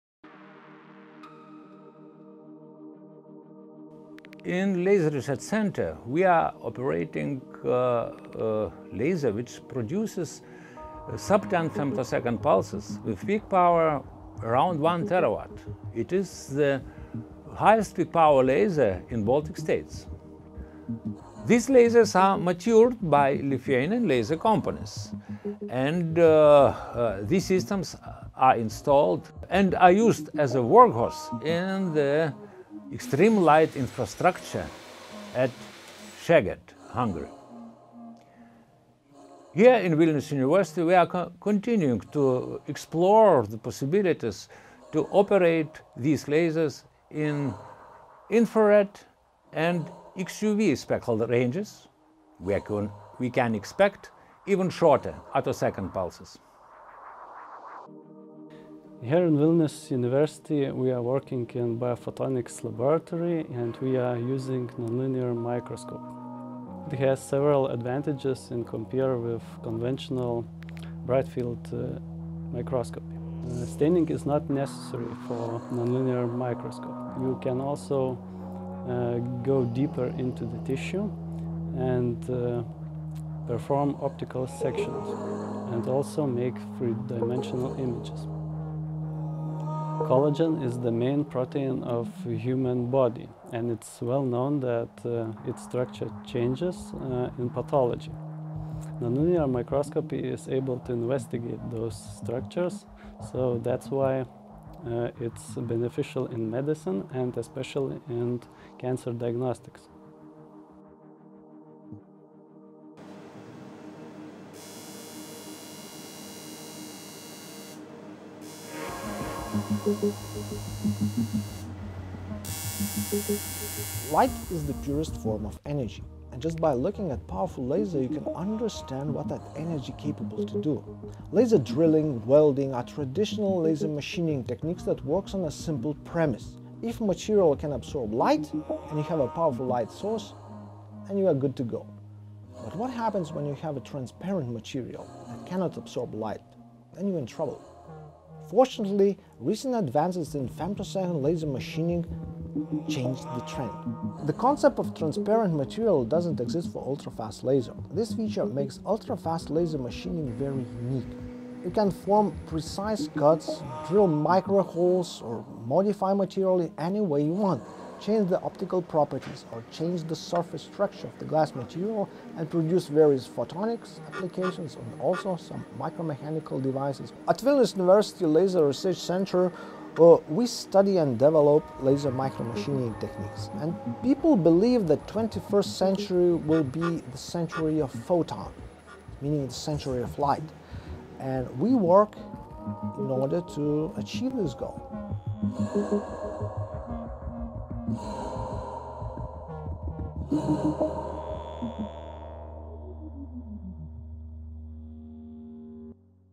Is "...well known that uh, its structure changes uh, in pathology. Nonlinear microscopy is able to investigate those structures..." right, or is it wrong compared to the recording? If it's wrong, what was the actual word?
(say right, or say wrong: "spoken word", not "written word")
right.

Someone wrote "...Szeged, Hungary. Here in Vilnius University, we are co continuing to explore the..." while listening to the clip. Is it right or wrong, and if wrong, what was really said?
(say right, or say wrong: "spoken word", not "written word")
right.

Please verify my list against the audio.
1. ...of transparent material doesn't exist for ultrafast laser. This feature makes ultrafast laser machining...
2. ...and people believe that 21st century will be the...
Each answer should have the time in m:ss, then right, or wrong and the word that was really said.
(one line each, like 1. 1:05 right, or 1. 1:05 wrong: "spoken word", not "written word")
1. 2:34 right
2. 3:03 right.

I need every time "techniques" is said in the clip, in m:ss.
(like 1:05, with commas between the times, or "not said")
2:14, 3:02.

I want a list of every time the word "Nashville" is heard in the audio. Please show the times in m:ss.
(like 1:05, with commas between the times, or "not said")
not said.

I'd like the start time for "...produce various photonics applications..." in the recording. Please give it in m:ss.
2:52.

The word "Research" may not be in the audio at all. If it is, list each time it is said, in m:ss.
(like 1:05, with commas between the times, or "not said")
0:05, 2:58.